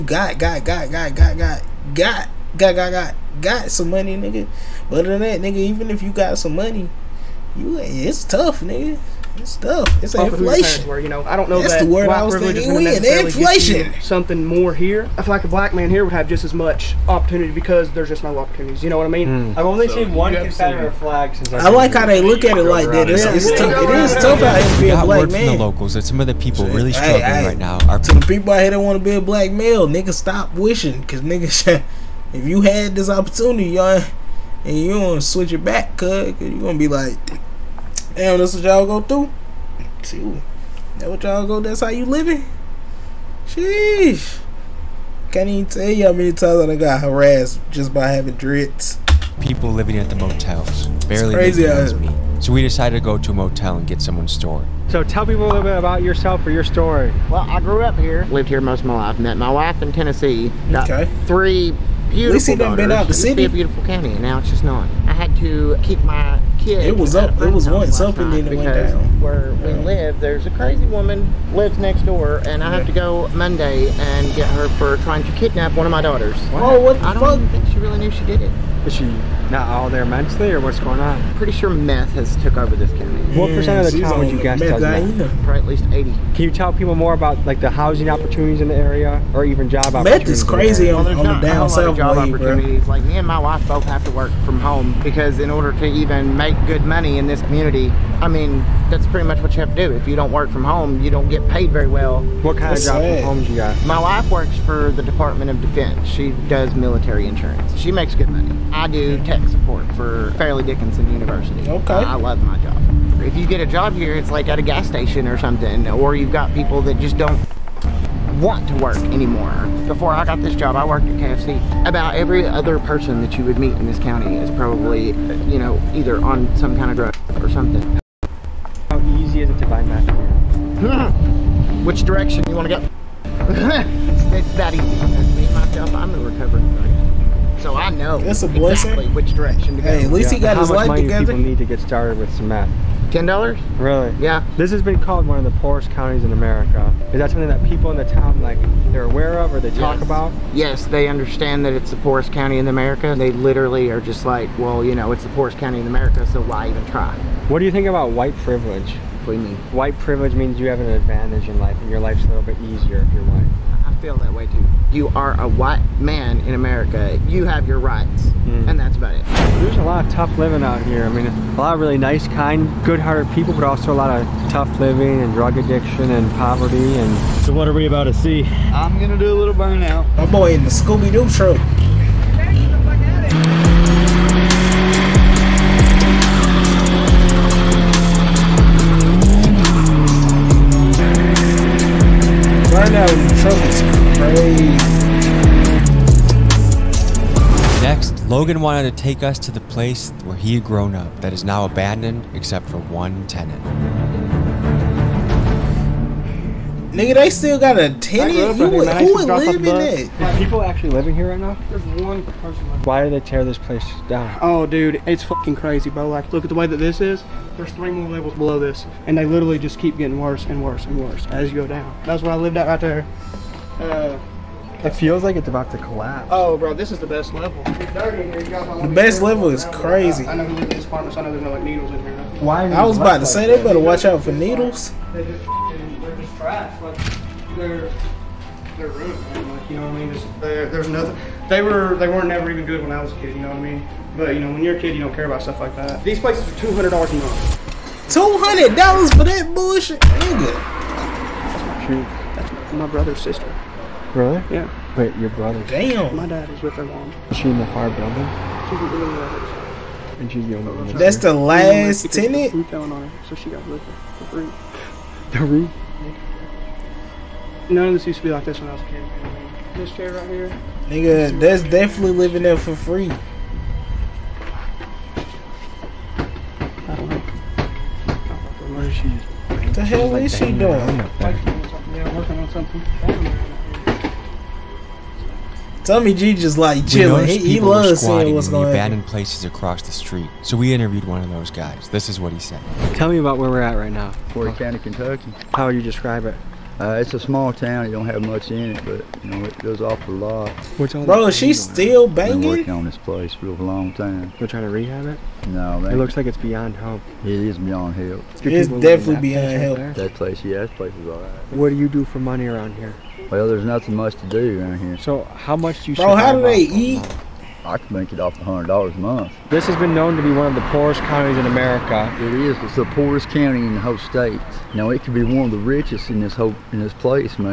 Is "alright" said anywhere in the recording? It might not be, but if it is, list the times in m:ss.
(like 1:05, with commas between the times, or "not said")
5:11.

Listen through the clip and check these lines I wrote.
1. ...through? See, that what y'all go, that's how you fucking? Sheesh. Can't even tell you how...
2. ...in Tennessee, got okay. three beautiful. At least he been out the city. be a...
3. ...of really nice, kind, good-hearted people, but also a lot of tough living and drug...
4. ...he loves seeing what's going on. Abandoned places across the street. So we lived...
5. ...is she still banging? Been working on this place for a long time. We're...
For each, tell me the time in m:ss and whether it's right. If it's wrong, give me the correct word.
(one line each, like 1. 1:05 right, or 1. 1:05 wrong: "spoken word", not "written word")
1. 0:39 wrong: "living", not "fucking"
2. 0:59 right
3. 2:51 right
4. 4:47 wrong: "interviewed", not "lived"
5. 5:01 right.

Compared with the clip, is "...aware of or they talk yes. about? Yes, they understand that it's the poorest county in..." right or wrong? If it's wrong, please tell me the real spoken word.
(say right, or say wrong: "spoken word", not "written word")
right.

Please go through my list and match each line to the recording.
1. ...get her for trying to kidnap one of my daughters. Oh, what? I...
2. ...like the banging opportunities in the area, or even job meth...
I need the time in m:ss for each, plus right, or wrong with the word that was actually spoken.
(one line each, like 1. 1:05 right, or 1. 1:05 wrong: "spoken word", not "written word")
1. 1:14 right
2. 1:27 wrong: "housing", not "banging".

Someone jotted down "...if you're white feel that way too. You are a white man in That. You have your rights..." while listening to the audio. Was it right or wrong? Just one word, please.
wrong.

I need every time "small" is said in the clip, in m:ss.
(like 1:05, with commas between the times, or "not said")
4:57.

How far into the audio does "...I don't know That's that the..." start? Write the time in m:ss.
0:11.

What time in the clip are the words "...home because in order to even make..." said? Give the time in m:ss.
1:34.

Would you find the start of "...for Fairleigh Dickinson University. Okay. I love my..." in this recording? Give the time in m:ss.
1:49.